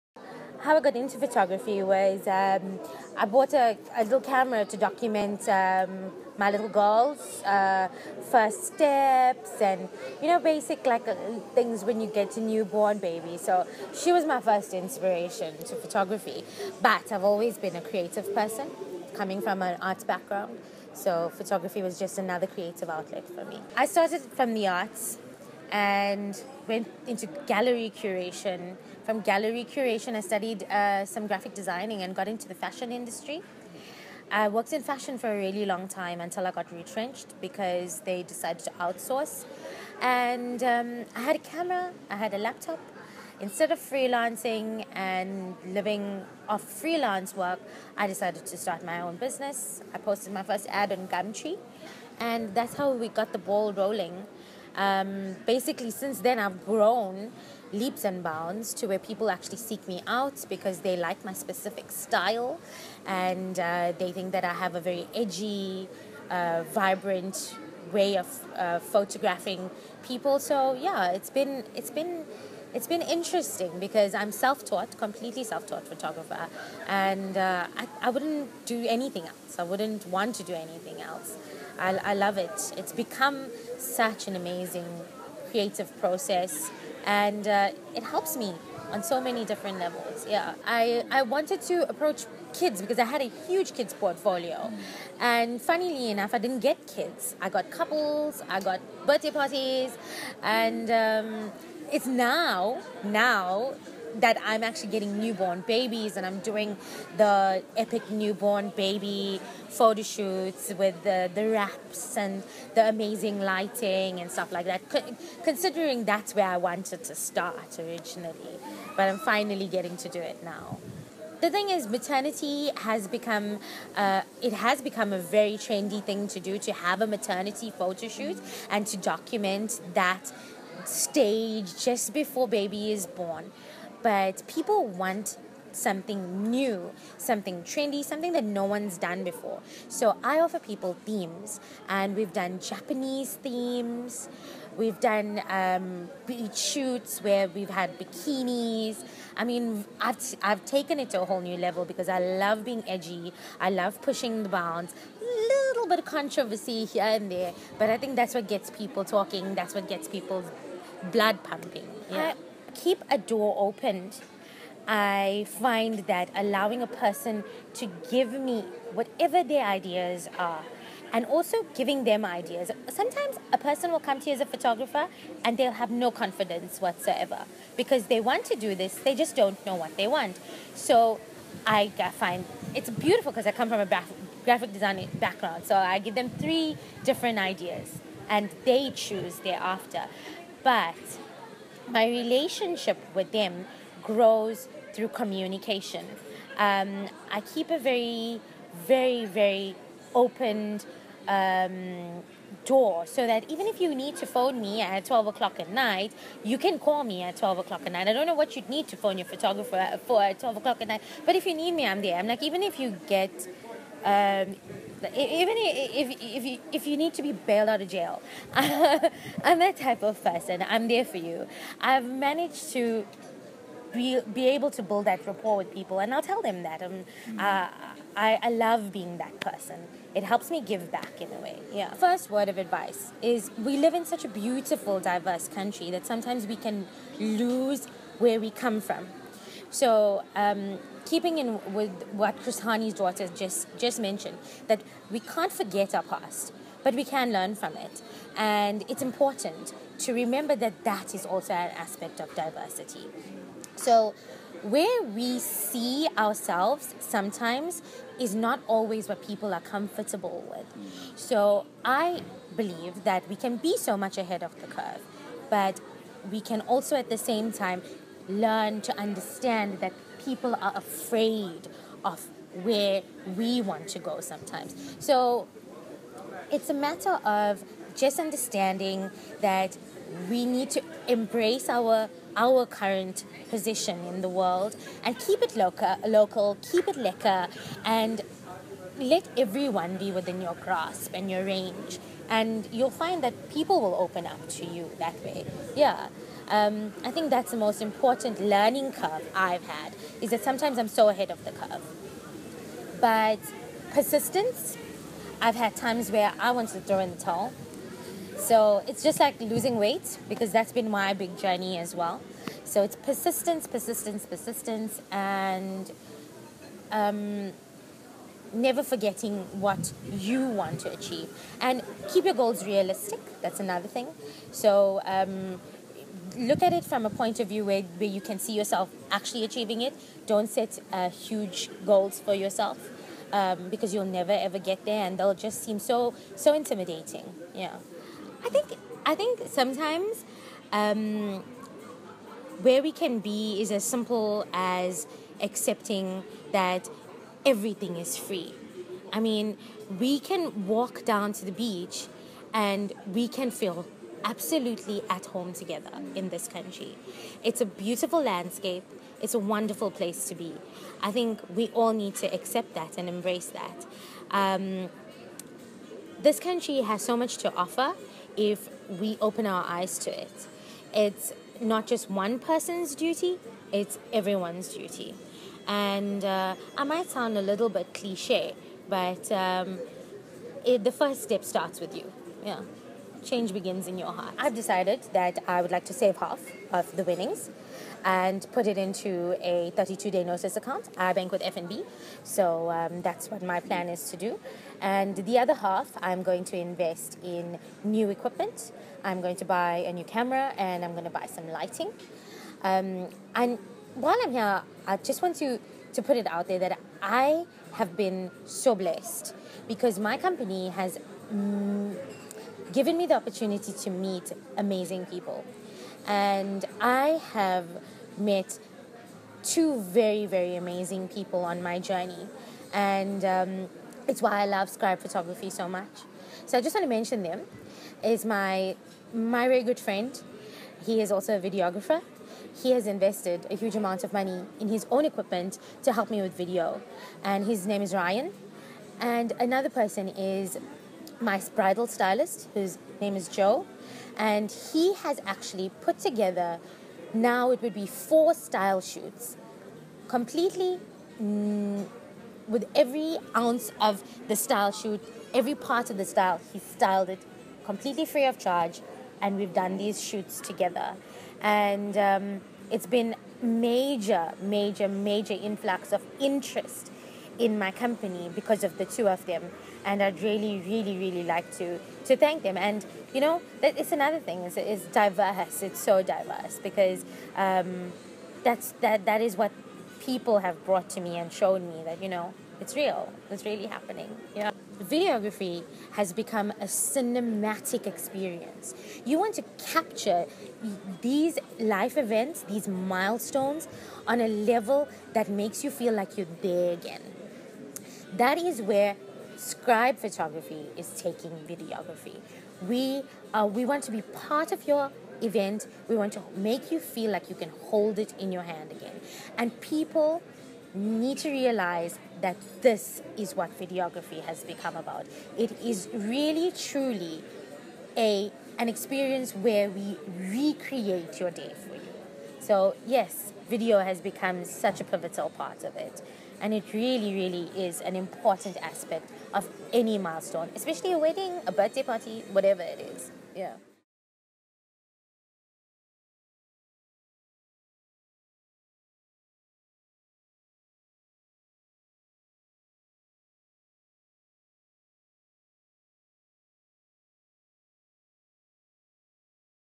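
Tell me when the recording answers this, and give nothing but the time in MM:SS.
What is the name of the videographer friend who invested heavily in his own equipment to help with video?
07:17.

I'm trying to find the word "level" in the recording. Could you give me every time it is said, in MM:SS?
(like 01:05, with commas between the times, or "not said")
01:29, 02:31, 08:14.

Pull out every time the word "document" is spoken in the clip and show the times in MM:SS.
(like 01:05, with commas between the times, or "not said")
00:04, 02:08.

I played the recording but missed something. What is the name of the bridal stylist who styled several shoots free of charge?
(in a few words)
Joe.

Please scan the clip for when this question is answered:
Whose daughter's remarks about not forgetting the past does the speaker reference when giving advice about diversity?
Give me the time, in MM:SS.
04:02.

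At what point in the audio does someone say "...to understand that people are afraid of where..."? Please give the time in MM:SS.
04:28.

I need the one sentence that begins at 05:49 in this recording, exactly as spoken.
I mean, we can walk down to the beach and we can feel absolutely at home together in this country.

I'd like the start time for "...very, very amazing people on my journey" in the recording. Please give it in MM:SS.
06:59.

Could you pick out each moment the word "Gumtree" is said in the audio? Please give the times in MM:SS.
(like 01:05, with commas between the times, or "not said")
00:51.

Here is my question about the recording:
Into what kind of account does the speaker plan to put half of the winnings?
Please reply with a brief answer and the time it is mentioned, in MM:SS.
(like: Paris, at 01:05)
32-day notice account, at 06:29.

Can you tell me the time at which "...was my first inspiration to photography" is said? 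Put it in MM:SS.
00:14.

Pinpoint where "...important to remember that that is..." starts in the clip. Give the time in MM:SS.
04:09.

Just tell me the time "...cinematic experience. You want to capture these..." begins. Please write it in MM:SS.
08:06.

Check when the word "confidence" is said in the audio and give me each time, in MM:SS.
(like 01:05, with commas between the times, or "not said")
02:56.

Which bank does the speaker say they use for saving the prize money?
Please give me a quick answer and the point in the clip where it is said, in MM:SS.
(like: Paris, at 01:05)
FNB, at 06:31.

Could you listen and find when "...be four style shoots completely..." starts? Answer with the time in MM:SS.
07:27.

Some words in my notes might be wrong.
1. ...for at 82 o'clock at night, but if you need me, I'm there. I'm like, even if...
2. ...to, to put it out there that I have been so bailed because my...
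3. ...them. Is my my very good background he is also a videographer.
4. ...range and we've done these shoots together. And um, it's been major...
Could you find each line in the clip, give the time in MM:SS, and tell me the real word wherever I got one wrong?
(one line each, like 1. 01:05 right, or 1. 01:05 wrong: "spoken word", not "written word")
1. 03:30 wrong: "12", not "82"
2. 06:45 wrong: "blessed", not "bailed"
3. 07:07 wrong: "friend", not "background"
4. 07:38 wrong: "charge", not "range".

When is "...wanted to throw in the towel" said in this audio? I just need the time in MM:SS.
05:06.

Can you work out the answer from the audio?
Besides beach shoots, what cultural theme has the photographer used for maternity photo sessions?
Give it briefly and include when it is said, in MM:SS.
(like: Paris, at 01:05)
Japanese, at 02:22.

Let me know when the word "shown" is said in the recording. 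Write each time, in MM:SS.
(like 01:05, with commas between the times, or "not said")
08:01.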